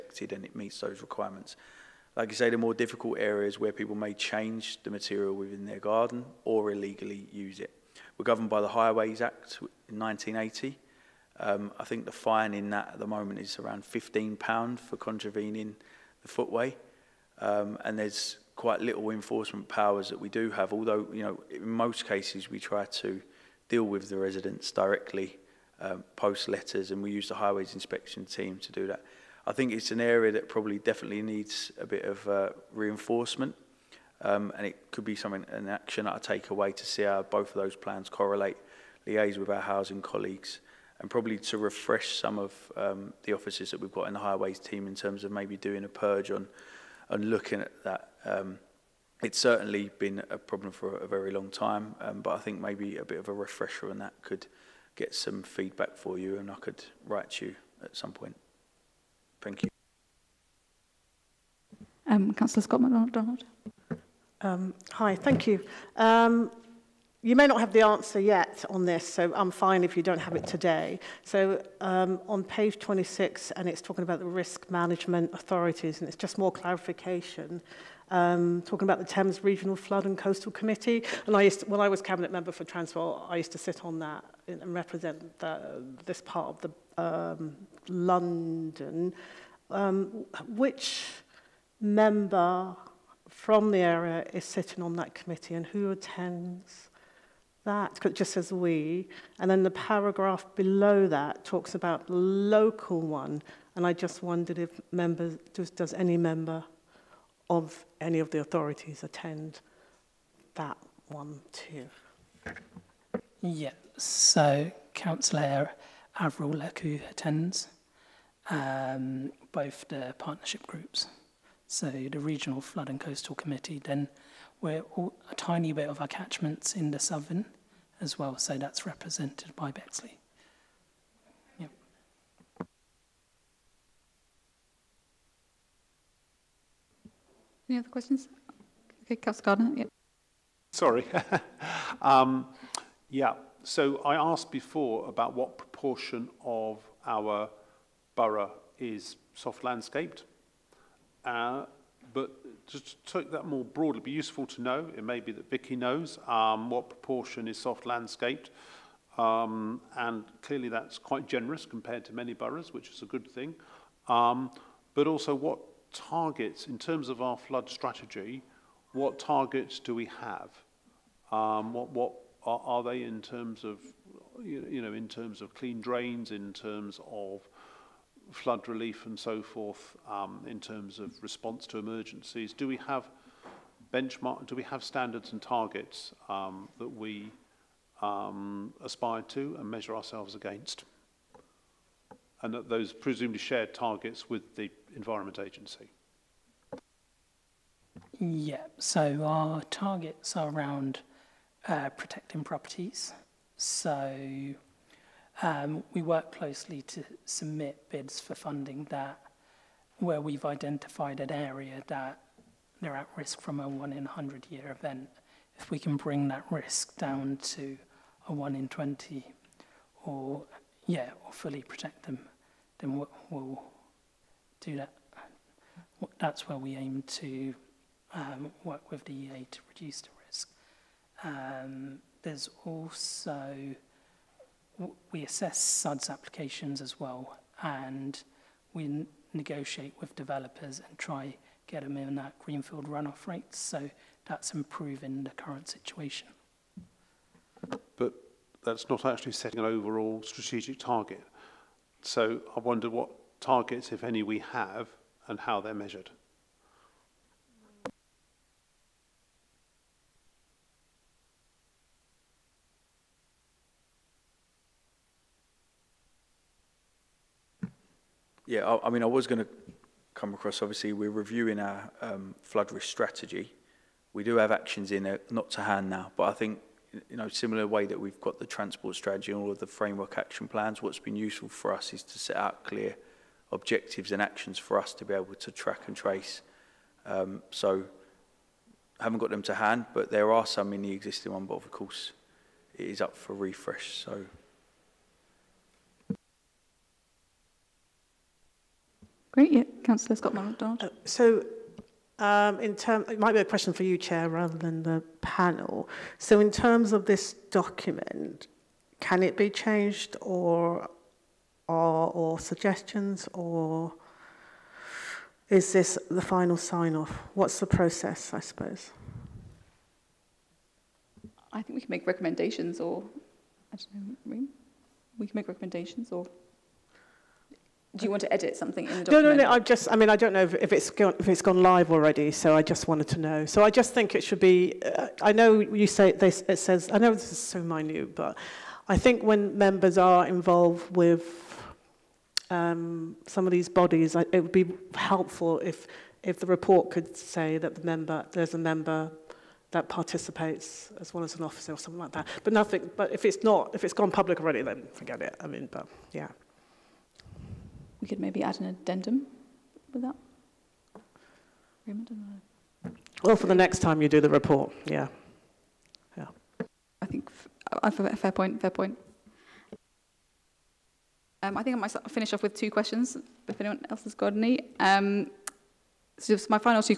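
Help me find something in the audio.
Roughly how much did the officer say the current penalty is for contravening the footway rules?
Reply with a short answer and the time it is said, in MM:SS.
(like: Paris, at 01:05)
£15, at 00:13.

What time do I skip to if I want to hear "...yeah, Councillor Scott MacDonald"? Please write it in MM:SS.
04:59.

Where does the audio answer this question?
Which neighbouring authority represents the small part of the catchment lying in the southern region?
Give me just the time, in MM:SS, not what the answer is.
02:09.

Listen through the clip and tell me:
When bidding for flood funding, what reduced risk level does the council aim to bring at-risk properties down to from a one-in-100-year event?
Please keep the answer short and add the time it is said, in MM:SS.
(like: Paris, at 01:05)
one in 20, at 03:38.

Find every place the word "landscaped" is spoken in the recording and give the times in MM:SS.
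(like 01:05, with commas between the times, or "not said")
02:29, 02:37.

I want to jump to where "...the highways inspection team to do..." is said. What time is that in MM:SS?
00:27.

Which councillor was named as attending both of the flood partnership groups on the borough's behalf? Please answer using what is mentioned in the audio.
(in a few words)
Averil Lekau.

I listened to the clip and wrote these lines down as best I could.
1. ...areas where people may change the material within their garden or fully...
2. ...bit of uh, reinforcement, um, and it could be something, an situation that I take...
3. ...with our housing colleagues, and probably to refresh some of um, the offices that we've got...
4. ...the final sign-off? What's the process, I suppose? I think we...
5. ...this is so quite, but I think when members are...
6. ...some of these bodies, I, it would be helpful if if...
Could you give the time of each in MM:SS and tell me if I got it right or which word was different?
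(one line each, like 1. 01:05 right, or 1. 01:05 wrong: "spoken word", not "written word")
1. 00:03 wrong: "illegally", not "fully"
2. 00:31 wrong: "action", not "situation"
3. 00:39 right
4. 05:16 right
5. 05:37 wrong: "minute", not "quite"
6. 05:43 right.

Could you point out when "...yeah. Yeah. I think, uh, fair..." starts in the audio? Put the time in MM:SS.
06:04.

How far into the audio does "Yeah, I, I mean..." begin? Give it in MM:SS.
04:28.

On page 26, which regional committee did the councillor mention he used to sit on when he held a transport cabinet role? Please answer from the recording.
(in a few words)
Thames Regional Flood and Coastal Committee.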